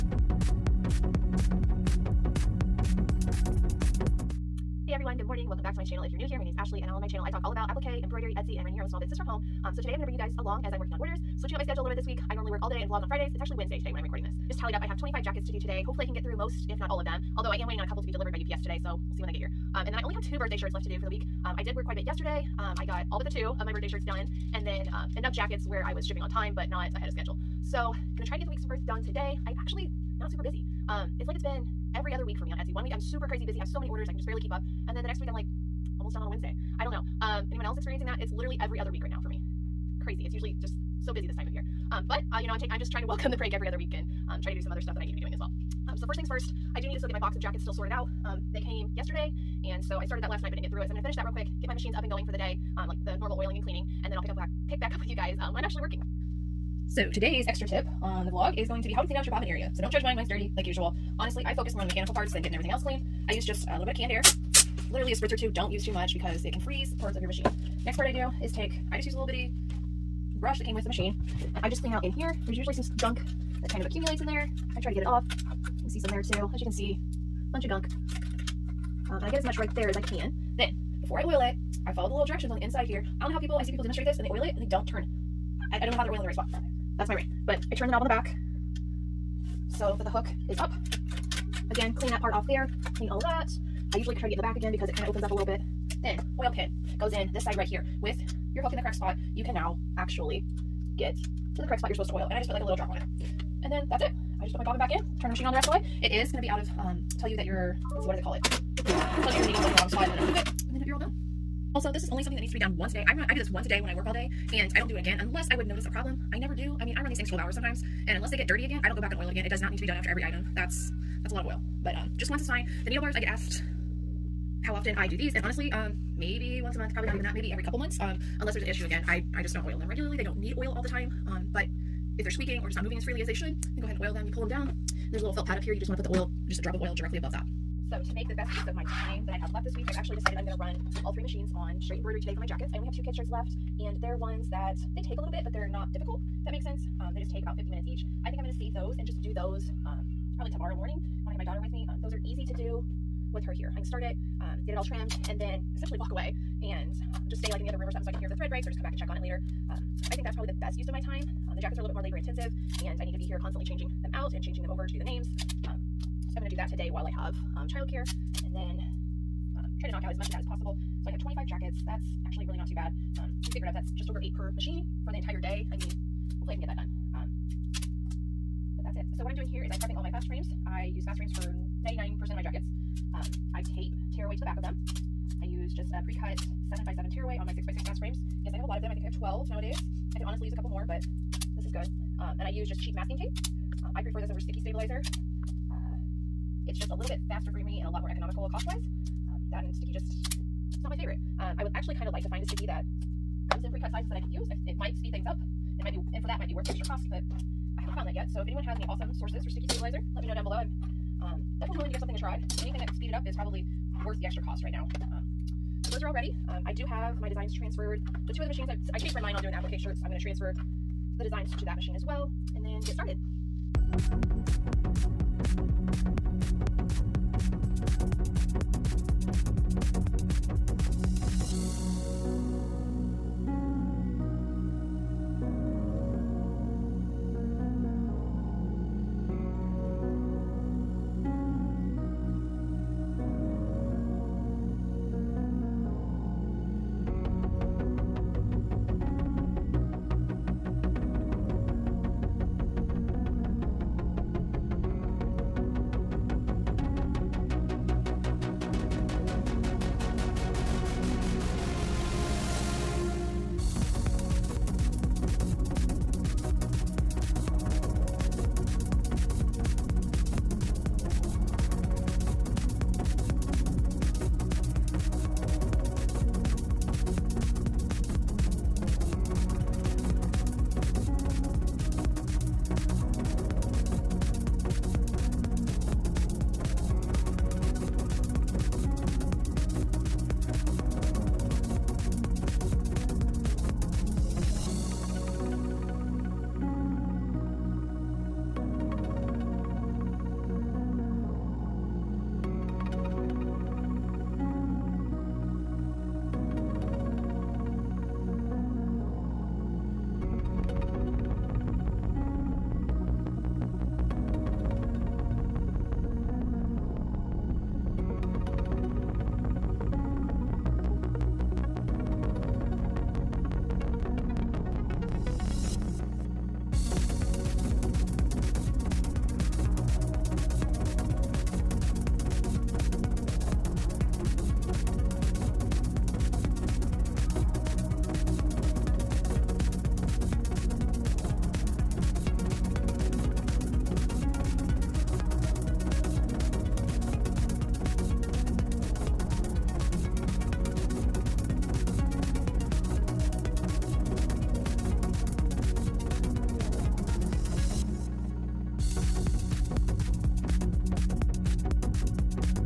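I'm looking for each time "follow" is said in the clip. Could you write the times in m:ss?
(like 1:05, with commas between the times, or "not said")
1:21.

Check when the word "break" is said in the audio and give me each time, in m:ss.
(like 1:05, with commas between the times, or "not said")
0:43, 2:38.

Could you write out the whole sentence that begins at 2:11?
Um, but if they're squeaking or just not moving as freely as they should, then go ahead and oil them.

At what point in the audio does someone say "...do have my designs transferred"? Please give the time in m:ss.
3:36.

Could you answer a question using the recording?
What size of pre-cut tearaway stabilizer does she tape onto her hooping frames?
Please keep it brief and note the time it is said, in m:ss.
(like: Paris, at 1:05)
7x7, at 3:06.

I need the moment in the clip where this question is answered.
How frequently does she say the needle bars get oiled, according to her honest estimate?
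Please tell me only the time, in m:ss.
2:06.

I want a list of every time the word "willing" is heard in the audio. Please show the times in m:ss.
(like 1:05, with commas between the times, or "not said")
3:31.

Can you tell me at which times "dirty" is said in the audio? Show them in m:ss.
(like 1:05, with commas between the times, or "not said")
1:00, 1:58.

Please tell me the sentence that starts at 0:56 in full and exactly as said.
So today's extra tip on the vlog is going to be how to clean out your bobbin area.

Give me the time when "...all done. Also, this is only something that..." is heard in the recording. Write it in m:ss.
1:50.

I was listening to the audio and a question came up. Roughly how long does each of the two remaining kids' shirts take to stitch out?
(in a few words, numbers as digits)
50 minutes.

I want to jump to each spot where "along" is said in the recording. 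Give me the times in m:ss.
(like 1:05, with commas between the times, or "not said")
0:10.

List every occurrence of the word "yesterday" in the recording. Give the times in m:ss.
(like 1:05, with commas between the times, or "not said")
0:22, 0:48.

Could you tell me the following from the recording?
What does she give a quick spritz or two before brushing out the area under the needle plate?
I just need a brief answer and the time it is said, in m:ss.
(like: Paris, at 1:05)
Canned air, at 1:03.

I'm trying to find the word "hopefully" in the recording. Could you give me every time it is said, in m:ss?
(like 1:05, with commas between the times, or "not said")
0:15, 2:56.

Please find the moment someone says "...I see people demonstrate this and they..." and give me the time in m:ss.
1:23.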